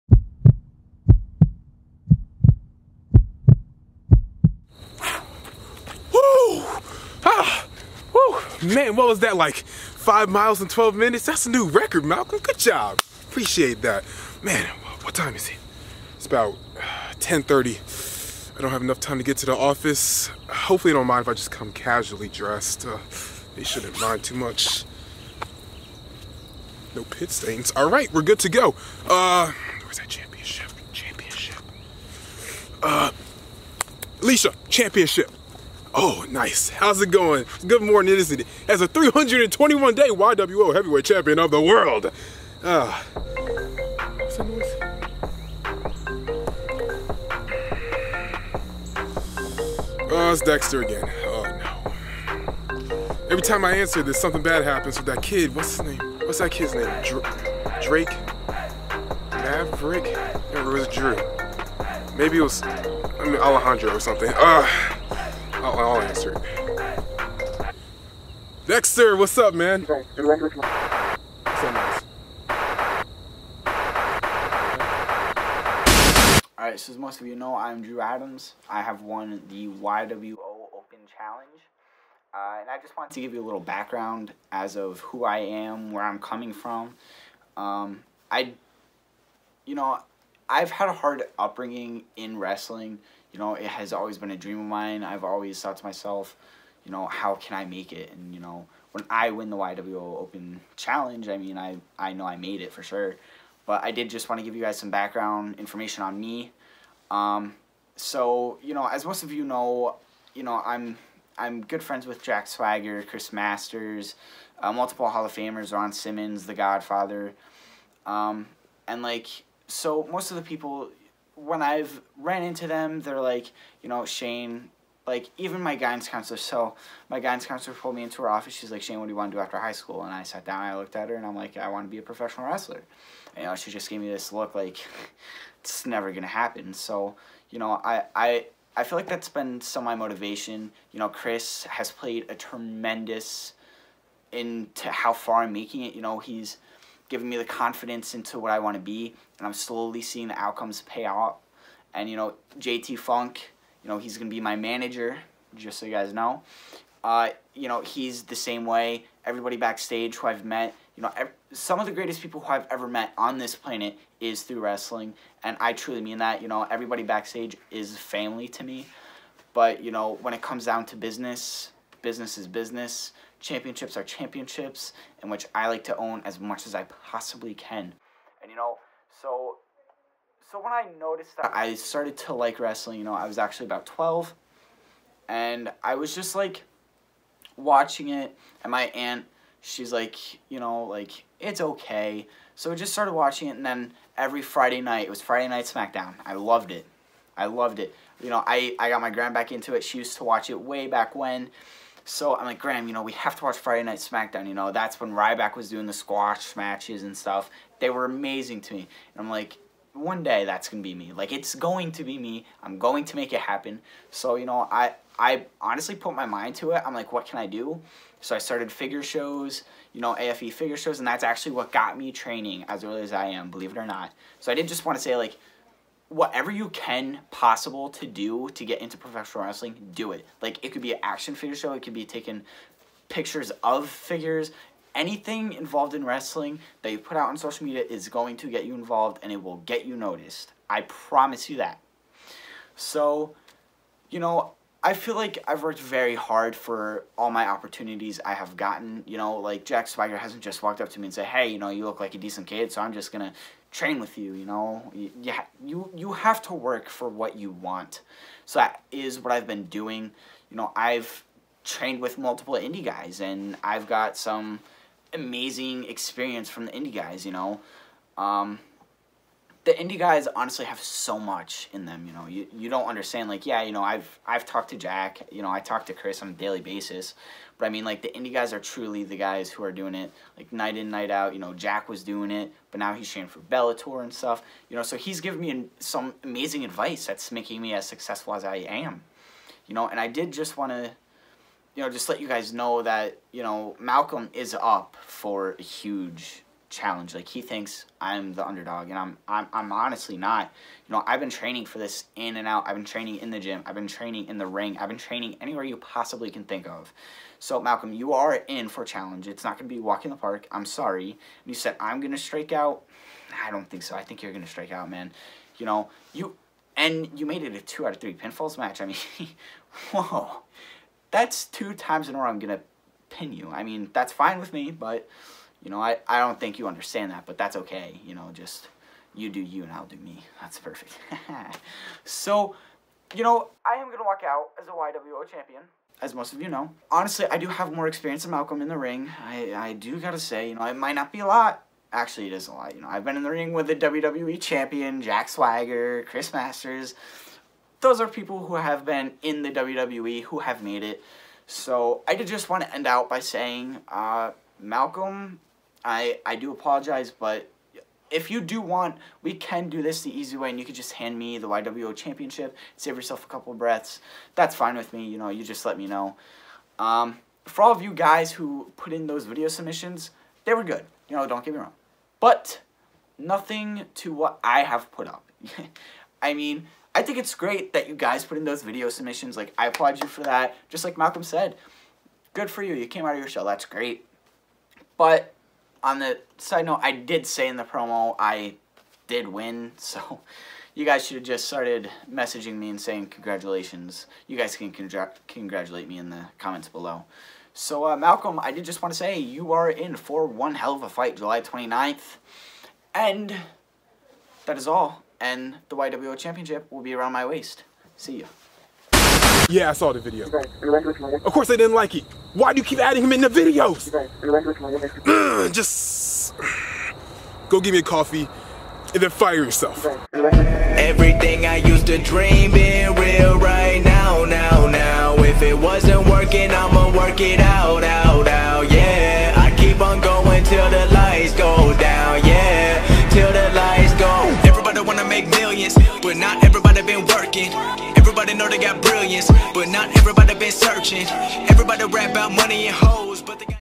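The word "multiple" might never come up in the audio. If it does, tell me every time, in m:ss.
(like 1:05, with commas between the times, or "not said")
1:54, 4:22.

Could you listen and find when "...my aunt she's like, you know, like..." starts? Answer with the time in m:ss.
3:08.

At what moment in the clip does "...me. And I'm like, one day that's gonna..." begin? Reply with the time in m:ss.
3:28.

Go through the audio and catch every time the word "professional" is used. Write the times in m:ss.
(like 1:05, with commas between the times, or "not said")
2:12, 3:48.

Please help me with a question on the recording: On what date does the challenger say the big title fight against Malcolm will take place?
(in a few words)
July 29.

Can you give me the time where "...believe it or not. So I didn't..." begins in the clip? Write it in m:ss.
3:43.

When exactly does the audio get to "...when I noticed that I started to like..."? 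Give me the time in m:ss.
3:00.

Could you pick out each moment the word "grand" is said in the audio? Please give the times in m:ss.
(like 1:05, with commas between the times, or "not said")
3:19.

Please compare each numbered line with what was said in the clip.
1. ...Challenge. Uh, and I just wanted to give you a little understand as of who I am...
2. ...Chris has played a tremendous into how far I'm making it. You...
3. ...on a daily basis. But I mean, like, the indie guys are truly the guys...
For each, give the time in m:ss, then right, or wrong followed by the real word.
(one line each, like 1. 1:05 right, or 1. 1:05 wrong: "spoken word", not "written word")
1. 1:21 wrong: "background", not "understand"
2. 2:21 right
3. 4:36 right.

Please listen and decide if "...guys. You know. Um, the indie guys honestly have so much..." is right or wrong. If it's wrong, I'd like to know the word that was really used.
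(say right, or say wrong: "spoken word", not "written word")
right.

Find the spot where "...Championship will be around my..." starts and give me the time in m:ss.
6:46.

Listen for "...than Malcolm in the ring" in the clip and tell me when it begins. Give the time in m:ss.
5:38.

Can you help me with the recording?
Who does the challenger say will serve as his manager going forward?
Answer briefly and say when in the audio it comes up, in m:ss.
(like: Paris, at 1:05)
JT Funk, at 2:32.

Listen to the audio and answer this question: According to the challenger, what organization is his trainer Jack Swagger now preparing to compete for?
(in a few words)
Bellator.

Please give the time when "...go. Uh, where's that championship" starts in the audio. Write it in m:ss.
0:28.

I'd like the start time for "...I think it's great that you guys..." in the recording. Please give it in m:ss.
6:16.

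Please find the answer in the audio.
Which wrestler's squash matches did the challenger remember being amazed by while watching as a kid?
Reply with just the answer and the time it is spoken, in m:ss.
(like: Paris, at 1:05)
Ryback, at 3:25.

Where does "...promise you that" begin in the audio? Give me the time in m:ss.
4:00.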